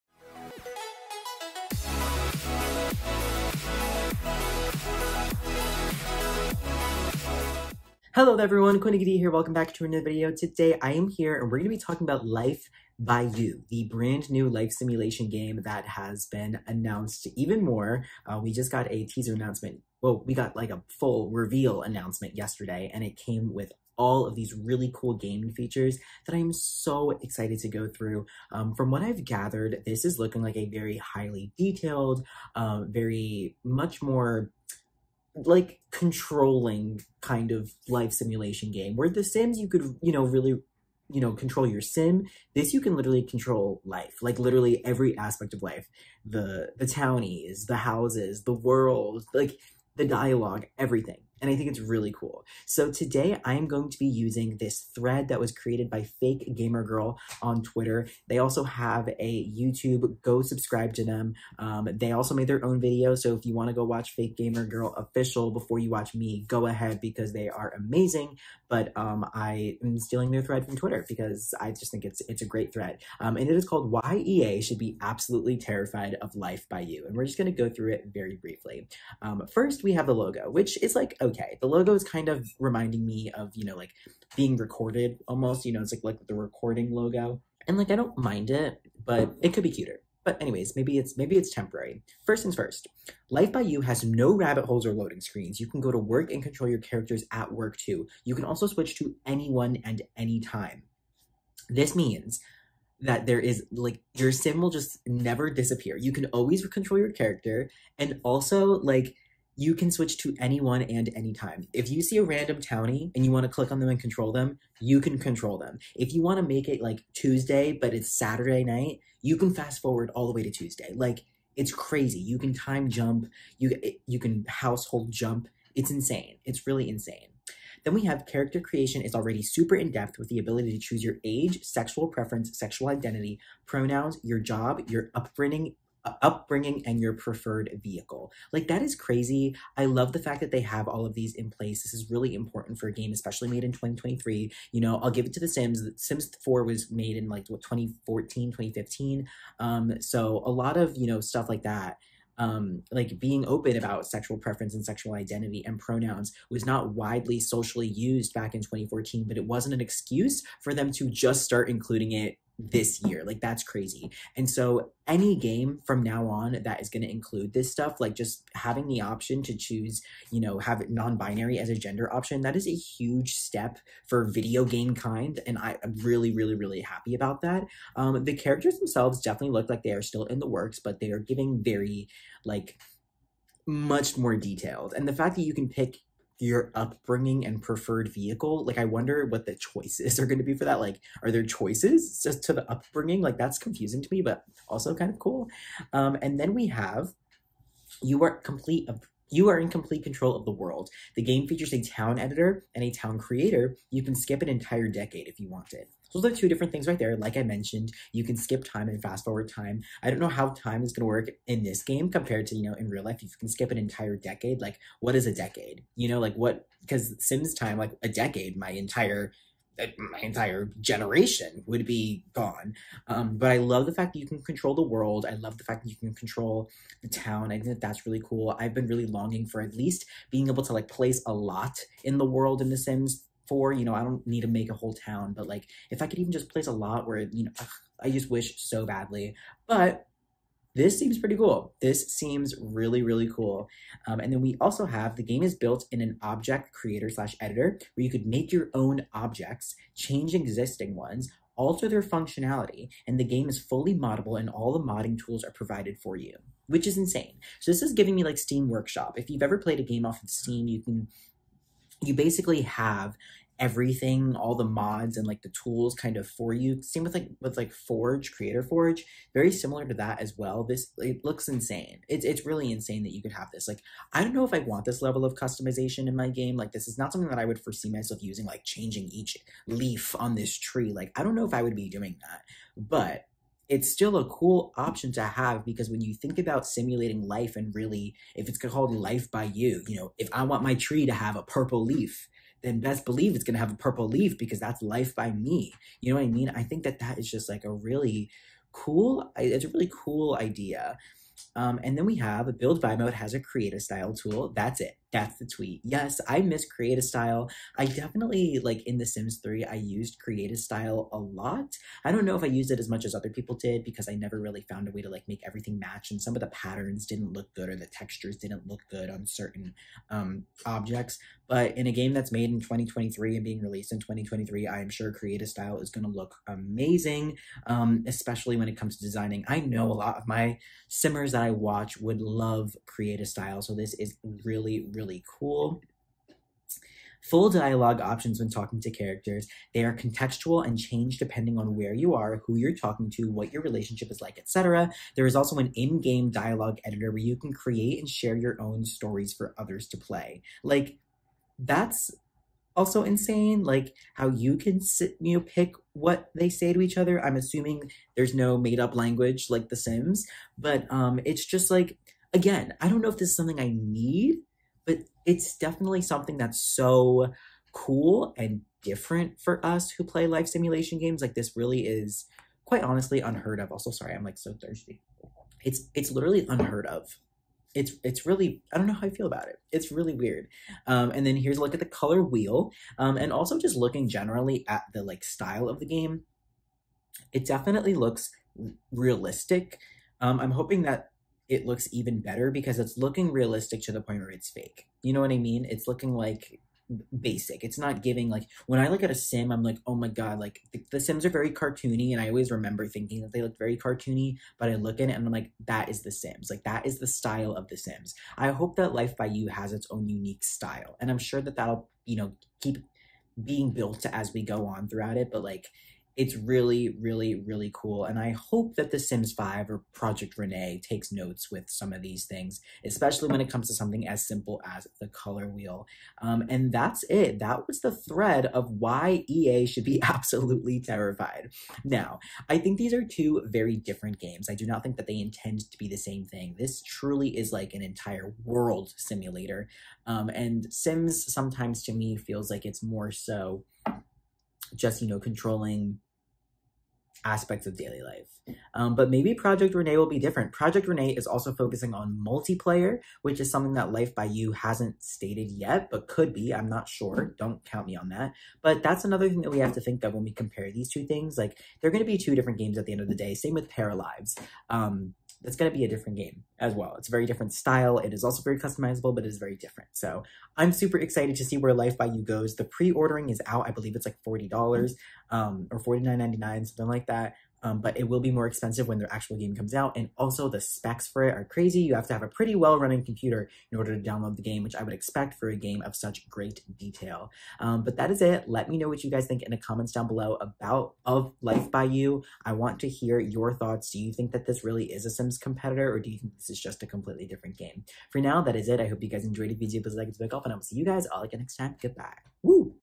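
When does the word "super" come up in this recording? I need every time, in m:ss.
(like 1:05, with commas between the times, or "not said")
2:09, 7:50.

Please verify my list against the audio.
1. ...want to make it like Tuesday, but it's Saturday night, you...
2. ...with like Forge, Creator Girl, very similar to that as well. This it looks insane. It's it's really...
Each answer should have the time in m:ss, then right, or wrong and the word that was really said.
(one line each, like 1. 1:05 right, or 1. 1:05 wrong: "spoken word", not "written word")
1. 1:56 right
2. 4:27 wrong: "Forge", not "Girl".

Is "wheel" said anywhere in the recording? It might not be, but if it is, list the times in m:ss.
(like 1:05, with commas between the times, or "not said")
6:22, 7:05.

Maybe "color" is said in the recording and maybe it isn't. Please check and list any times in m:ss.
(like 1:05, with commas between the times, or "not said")
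6:21, 7:05.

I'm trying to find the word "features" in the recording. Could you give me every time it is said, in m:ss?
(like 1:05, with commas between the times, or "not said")
0:25, 3:21.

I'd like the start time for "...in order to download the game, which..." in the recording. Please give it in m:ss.
8:03.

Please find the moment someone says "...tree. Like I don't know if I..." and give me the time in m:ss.
4:40.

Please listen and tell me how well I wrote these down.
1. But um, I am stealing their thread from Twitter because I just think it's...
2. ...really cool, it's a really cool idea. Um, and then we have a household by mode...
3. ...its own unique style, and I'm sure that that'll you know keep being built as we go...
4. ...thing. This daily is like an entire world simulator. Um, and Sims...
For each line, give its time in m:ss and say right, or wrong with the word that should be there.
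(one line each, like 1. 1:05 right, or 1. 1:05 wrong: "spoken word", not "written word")
1. 1:08 right
2. 4:57 wrong: "build", not "household"
3. 6:49 right
4. 7:16 wrong: "truly", not "daily".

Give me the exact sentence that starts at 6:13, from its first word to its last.
Also, sorry, I'm like so thirsty.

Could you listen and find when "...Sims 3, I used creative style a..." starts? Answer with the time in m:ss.
5:09.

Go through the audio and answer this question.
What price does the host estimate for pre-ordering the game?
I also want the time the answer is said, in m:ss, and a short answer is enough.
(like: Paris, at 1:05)
$49.99, at 7:55.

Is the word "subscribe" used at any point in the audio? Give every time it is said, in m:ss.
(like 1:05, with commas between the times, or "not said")
1:00, 8:20.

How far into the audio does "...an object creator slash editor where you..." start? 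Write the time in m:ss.
4:05.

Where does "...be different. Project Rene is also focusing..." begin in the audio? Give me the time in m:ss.
7:30.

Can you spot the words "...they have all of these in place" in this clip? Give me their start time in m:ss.
2:20.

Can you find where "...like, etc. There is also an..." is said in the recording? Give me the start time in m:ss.
5:44.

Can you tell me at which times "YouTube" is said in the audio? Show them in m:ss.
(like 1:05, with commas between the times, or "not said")
0:59.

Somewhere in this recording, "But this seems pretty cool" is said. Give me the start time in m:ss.
3:59.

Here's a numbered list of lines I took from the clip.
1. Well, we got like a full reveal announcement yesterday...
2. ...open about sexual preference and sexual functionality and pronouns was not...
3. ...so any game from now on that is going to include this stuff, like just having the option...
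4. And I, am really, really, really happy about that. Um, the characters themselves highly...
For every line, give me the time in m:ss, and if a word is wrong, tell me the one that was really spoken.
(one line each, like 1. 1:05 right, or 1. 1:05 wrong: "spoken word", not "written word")
1. 0:20 right
2. 2:33 wrong: "identity", not "functionality"
3. 2:44 right
4. 2:55 wrong: "definitely", not "highly".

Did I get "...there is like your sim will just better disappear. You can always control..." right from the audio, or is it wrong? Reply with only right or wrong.
wrong.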